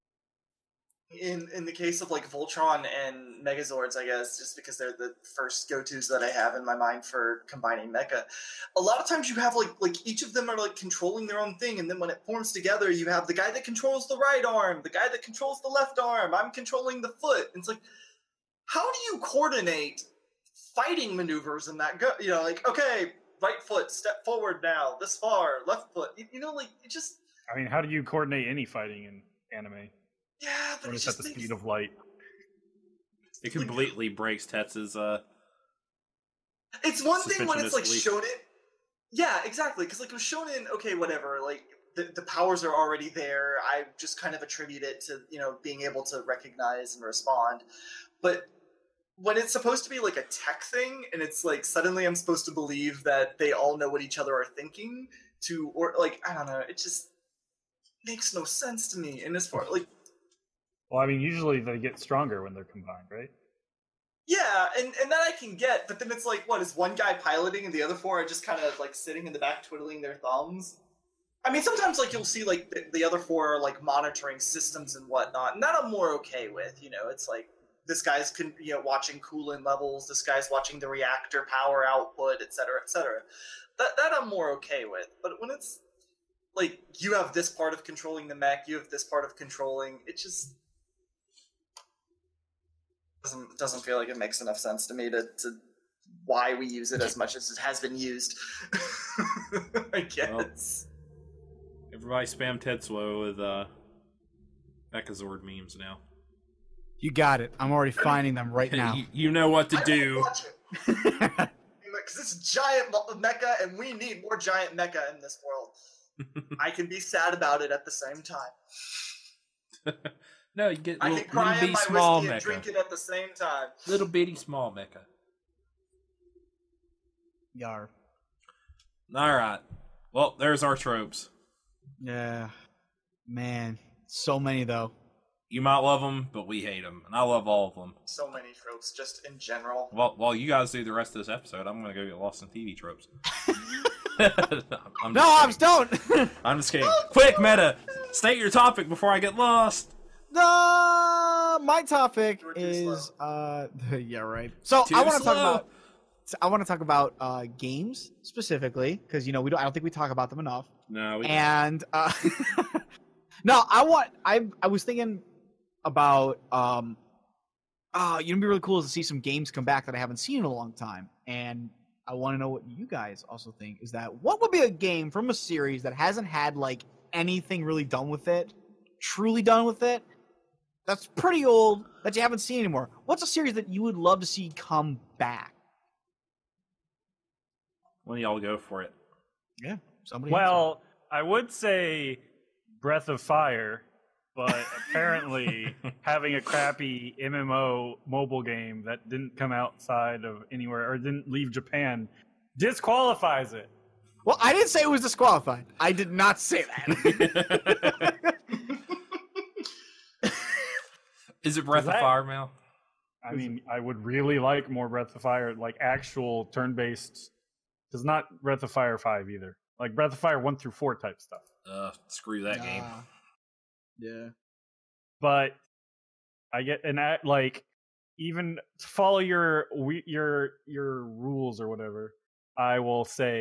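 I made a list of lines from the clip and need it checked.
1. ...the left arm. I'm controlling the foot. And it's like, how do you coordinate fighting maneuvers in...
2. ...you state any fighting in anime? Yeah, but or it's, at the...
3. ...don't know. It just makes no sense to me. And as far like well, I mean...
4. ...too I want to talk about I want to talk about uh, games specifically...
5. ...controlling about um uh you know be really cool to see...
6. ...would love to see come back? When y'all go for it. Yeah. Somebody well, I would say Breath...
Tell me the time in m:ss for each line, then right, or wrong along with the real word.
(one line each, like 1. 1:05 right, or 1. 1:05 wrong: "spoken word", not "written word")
1. 0:15 right
2. 0:27 wrong: "coordinate", not "state"
3. 0:56 right
4. 2:34 right
5. 2:44 wrong: "thinking", not "controlling"
6. 3:03 right.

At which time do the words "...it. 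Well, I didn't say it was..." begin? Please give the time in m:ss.
3:23.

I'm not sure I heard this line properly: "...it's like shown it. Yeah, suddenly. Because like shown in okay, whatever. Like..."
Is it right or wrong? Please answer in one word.
wrong.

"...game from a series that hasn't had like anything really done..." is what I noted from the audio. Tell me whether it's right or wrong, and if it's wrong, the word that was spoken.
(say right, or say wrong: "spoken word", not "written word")
right.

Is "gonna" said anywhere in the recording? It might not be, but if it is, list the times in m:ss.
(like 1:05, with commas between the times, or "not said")
2:21.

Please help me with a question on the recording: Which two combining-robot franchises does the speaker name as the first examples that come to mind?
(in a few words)
Voltron and Megazords.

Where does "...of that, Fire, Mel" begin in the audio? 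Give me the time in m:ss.
3:31.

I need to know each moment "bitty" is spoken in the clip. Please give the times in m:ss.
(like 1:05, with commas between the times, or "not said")
2:04.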